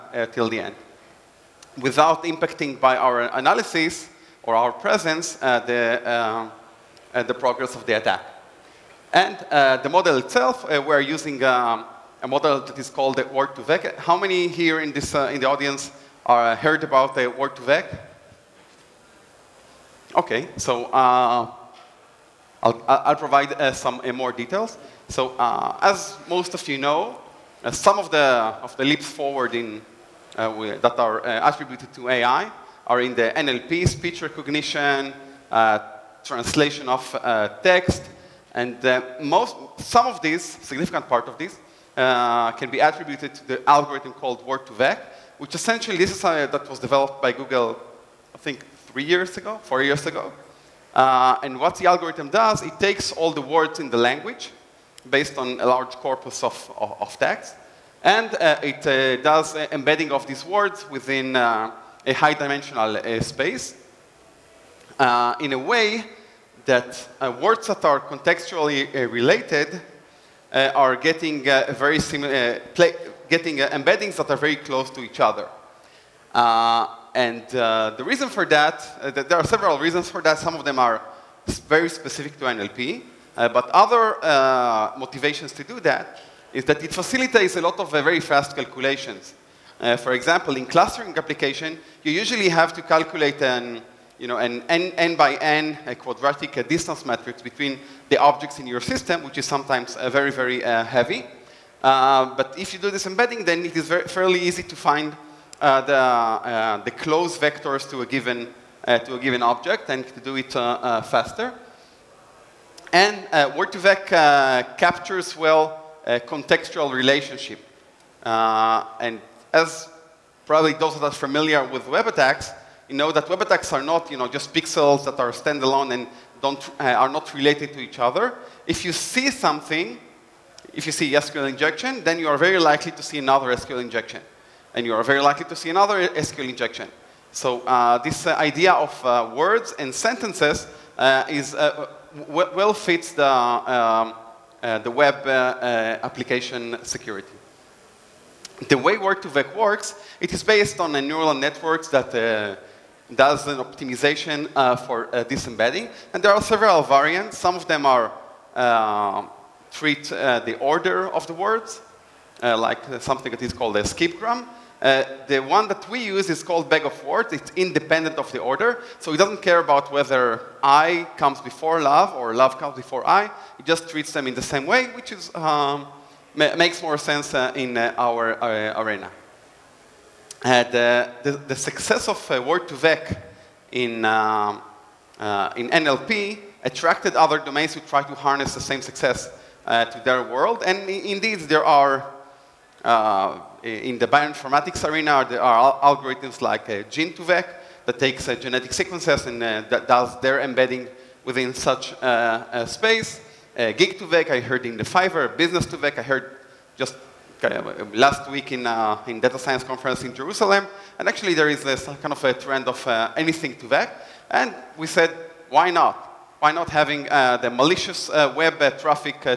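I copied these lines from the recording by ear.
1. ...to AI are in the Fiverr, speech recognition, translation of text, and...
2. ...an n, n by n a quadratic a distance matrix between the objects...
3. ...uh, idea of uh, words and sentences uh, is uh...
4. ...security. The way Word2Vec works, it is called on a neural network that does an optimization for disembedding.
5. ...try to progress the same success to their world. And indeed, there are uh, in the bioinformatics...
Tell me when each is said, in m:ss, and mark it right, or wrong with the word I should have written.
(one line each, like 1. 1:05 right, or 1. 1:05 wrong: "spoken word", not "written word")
1. 0:31 wrong: "NLP", not "Fiverr"
2. 1:34 right
3. 2:18 right
4. 2:26 wrong: "based", not "called"
5. 3:07 wrong: "harness", not "progress".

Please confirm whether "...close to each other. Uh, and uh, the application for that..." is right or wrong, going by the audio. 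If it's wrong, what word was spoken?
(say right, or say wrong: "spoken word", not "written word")
wrong: "reason", not "application".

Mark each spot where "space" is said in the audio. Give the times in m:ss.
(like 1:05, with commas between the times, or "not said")
1:03, 3:22.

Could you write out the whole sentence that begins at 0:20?
Okay, so I'll, I'll provide uh, some uh, more details.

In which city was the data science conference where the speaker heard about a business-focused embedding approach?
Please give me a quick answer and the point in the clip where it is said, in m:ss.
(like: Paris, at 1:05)
Jerusalem, at 3:30.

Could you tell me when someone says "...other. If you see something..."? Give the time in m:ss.
2:07.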